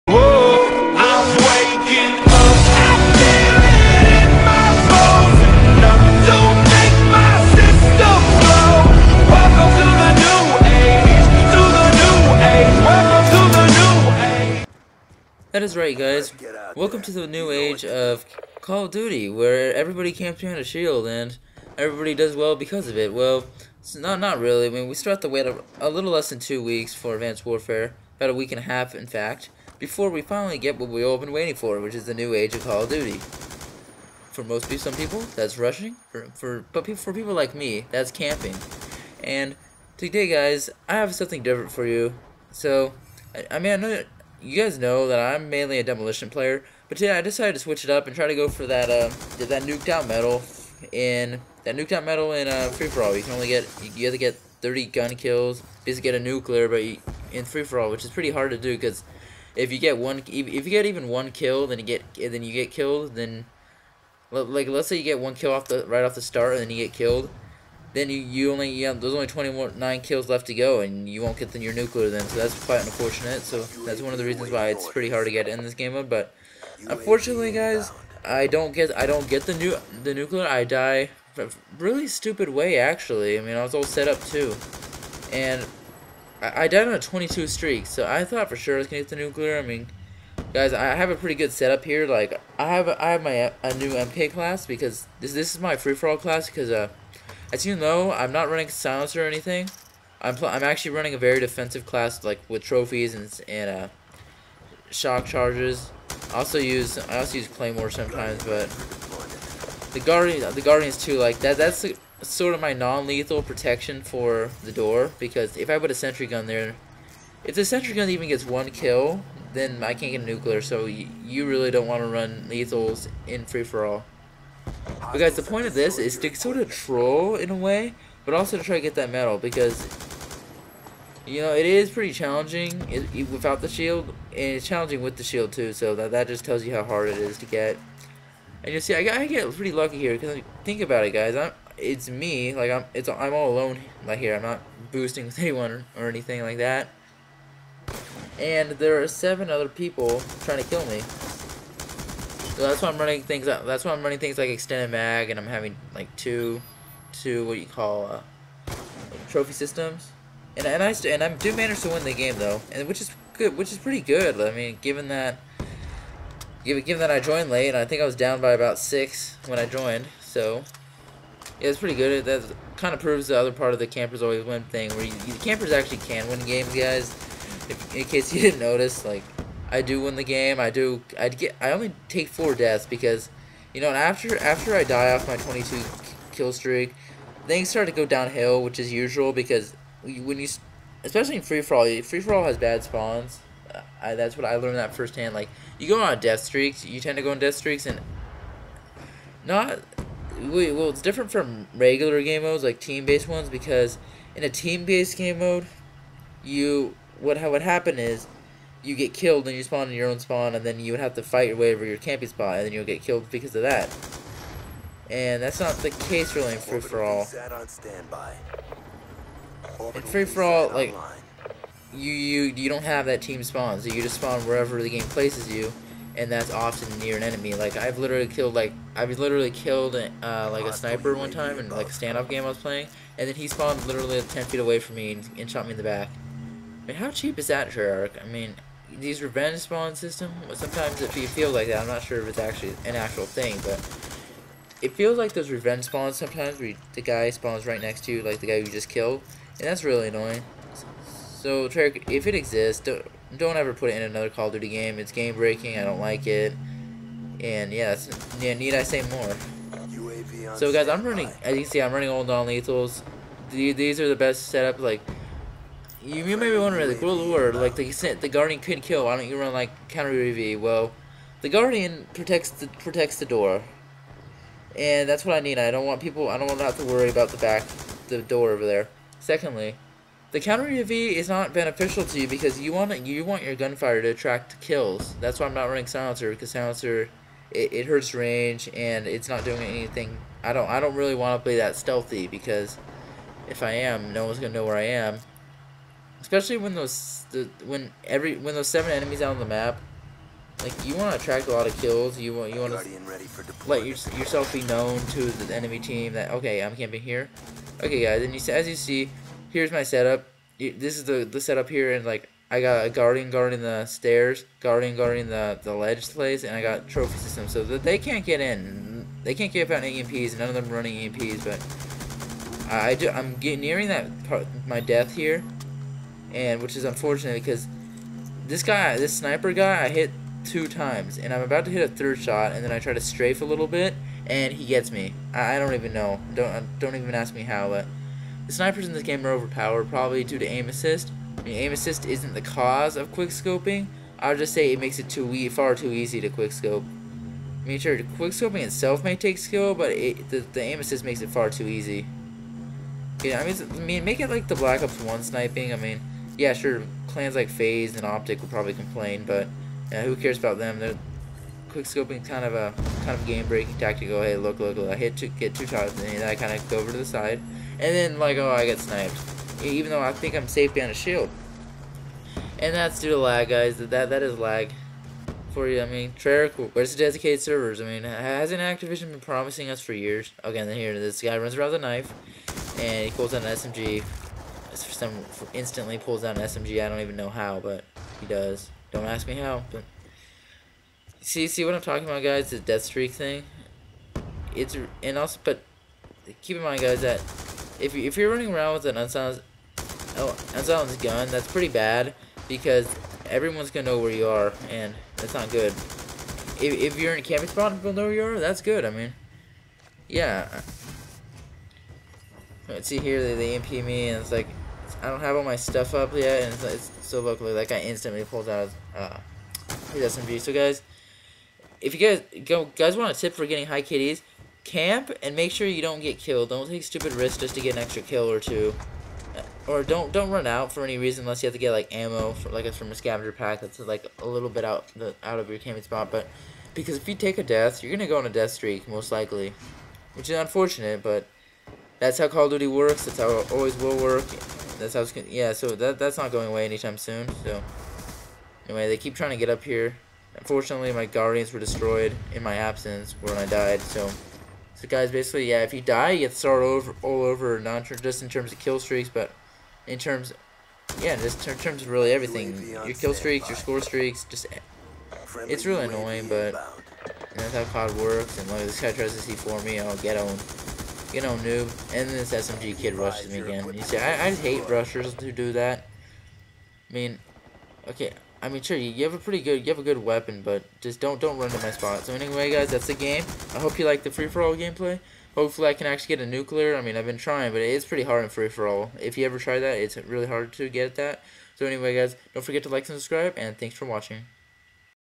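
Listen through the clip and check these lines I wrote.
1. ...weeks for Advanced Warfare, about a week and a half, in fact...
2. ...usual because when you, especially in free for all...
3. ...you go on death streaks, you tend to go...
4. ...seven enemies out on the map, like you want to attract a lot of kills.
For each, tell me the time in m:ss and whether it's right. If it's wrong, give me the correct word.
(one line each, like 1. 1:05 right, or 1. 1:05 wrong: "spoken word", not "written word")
1. 0:26 right
2. 3:08 right
3. 3:15 right
4. 4:58 right.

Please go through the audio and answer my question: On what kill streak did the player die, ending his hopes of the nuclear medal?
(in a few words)
22.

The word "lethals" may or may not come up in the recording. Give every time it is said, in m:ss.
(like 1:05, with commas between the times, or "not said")
1:52, 2:02, 4:22.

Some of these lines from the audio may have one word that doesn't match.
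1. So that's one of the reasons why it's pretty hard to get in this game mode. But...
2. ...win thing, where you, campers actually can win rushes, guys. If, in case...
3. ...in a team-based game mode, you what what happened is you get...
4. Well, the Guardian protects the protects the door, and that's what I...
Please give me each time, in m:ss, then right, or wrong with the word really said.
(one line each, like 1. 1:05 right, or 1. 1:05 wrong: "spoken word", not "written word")
1. 1:13 right
2. 2:54 wrong: "games", not "rushes"
3. 3:24 right
4. 4:30 right.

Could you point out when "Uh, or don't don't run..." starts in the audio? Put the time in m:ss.
7:09.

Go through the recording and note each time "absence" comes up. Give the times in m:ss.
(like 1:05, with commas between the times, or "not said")
7:32.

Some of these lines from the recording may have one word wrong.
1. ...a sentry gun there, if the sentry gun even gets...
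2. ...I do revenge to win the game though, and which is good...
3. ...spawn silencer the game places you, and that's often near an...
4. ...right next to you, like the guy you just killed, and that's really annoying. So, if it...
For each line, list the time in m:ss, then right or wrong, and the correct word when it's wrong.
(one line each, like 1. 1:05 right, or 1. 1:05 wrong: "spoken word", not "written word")
1. 1:55 right
2. 2:41 wrong: "manage", not "revenge"
3. 3:44 wrong: "wherever", not "silencer"
4. 4:07 right.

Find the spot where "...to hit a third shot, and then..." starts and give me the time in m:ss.
5:31.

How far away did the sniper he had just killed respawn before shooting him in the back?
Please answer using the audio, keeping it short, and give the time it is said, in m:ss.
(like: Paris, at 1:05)
10 feet, at 3:54.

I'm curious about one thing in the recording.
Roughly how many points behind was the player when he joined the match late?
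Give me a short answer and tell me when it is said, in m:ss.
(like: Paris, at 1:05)
About 6, at 2:48.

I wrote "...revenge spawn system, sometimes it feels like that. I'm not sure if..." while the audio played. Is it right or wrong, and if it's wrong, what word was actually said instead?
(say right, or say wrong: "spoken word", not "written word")
right.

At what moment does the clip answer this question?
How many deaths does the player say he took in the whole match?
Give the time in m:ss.
3:02.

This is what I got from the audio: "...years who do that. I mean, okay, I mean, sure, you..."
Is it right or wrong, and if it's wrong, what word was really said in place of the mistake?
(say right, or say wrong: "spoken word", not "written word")
wrong: "rushers", not "years".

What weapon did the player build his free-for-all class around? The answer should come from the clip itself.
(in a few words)
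MK.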